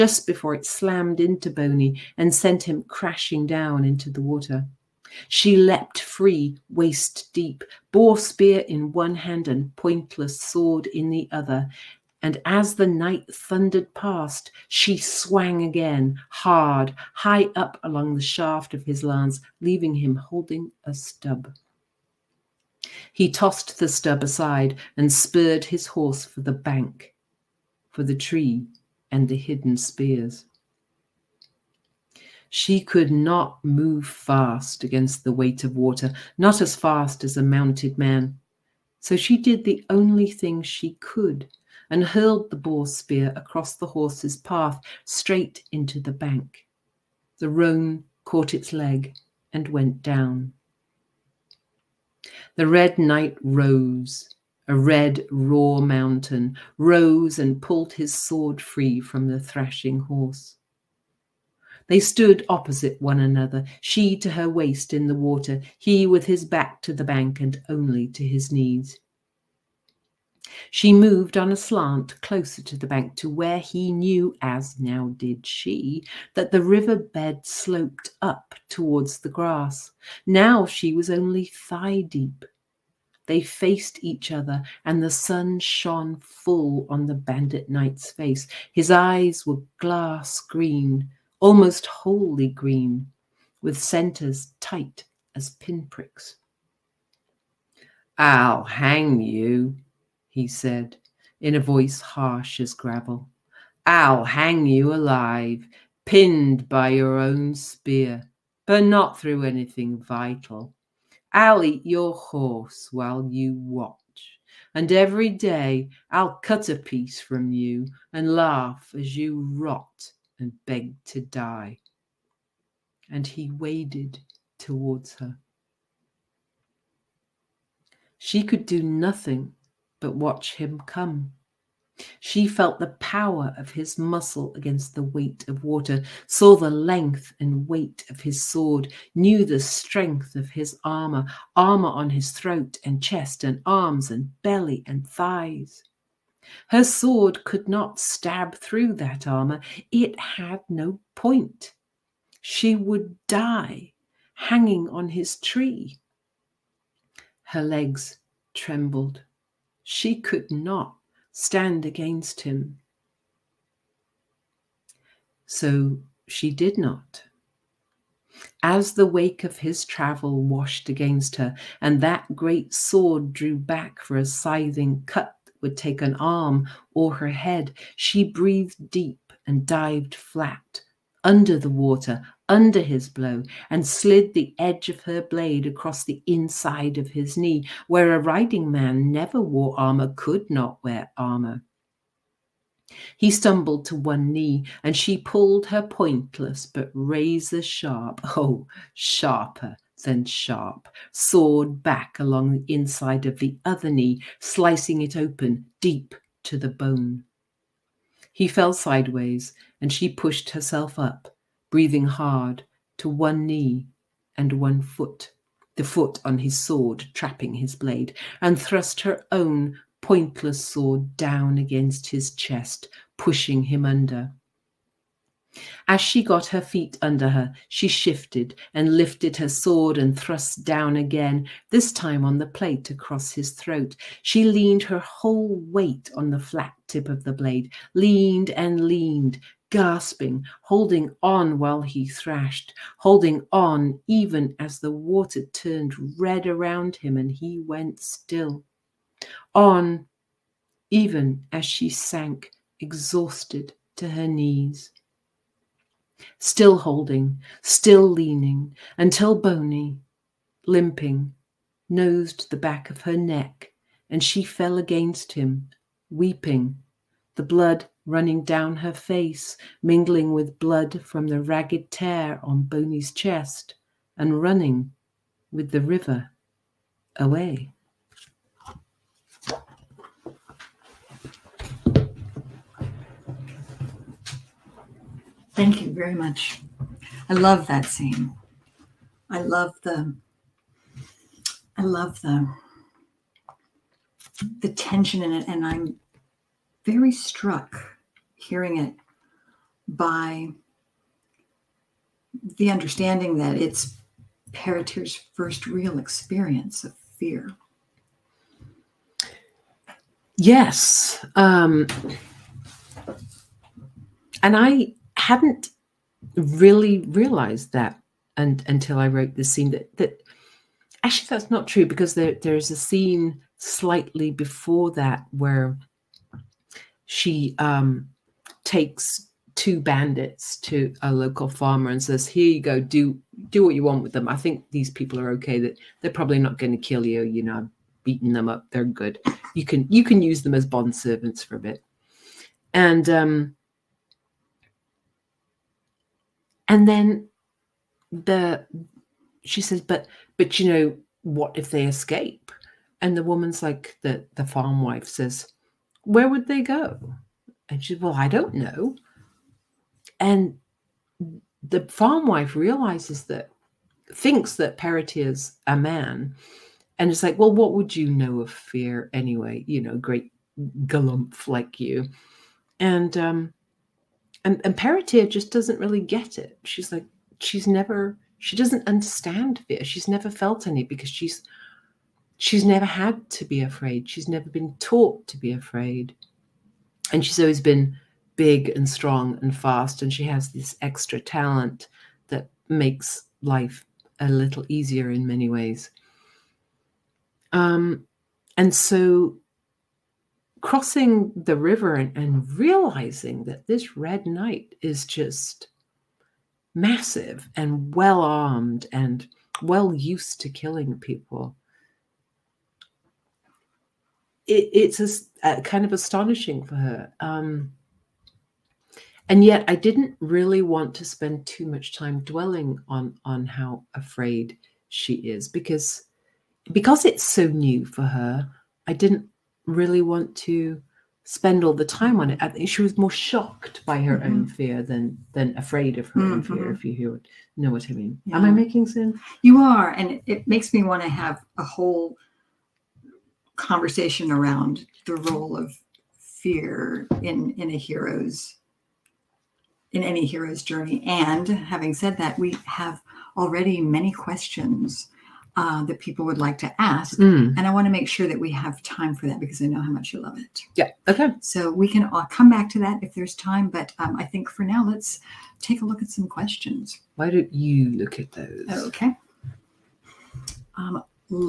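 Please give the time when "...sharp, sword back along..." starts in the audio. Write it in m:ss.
3:20.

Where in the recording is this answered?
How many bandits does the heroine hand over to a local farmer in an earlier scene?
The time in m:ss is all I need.
5:29.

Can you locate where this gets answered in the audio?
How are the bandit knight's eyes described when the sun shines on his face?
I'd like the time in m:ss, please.
1:29.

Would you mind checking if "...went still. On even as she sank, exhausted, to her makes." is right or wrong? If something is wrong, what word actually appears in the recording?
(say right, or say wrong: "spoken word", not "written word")
wrong: "knees", not "makes".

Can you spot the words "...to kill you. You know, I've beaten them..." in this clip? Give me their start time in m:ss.
5:36.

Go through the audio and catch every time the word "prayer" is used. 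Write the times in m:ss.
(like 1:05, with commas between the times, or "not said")
not said.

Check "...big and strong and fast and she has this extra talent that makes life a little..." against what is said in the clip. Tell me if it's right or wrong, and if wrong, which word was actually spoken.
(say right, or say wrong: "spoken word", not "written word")
right.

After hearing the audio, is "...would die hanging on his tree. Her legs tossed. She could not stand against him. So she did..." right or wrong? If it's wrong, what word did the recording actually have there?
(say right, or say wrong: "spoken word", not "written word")
wrong: "trembled", not "tossed".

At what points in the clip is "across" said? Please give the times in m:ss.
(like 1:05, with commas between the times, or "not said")
0:43, 3:05, 3:52.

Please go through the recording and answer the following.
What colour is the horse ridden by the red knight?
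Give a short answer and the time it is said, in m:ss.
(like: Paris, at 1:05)
roan, at 0:47.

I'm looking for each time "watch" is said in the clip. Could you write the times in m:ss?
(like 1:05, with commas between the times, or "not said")
1:53, 2:10.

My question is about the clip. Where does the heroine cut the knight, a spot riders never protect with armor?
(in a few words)
inside of his knee.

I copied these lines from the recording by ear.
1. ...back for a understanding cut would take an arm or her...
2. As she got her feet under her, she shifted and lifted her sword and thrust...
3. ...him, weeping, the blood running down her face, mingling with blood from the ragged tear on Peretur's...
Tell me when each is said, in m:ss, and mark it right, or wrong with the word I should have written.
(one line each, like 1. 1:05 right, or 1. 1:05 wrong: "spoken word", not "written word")
1. 2:53 wrong: "scything", not "understanding"
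2. 3:45 right
3. 4:25 wrong: "Boney", not "Peretur".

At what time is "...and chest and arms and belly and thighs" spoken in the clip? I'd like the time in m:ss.
2:22.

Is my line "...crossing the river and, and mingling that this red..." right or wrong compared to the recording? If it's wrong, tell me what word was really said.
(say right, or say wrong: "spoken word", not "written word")
wrong: "realizing", not "mingling".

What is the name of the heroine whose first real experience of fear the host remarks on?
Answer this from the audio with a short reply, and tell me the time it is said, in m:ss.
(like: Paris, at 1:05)
Peretur, at 5:04.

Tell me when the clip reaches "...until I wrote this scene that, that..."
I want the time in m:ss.
5:18.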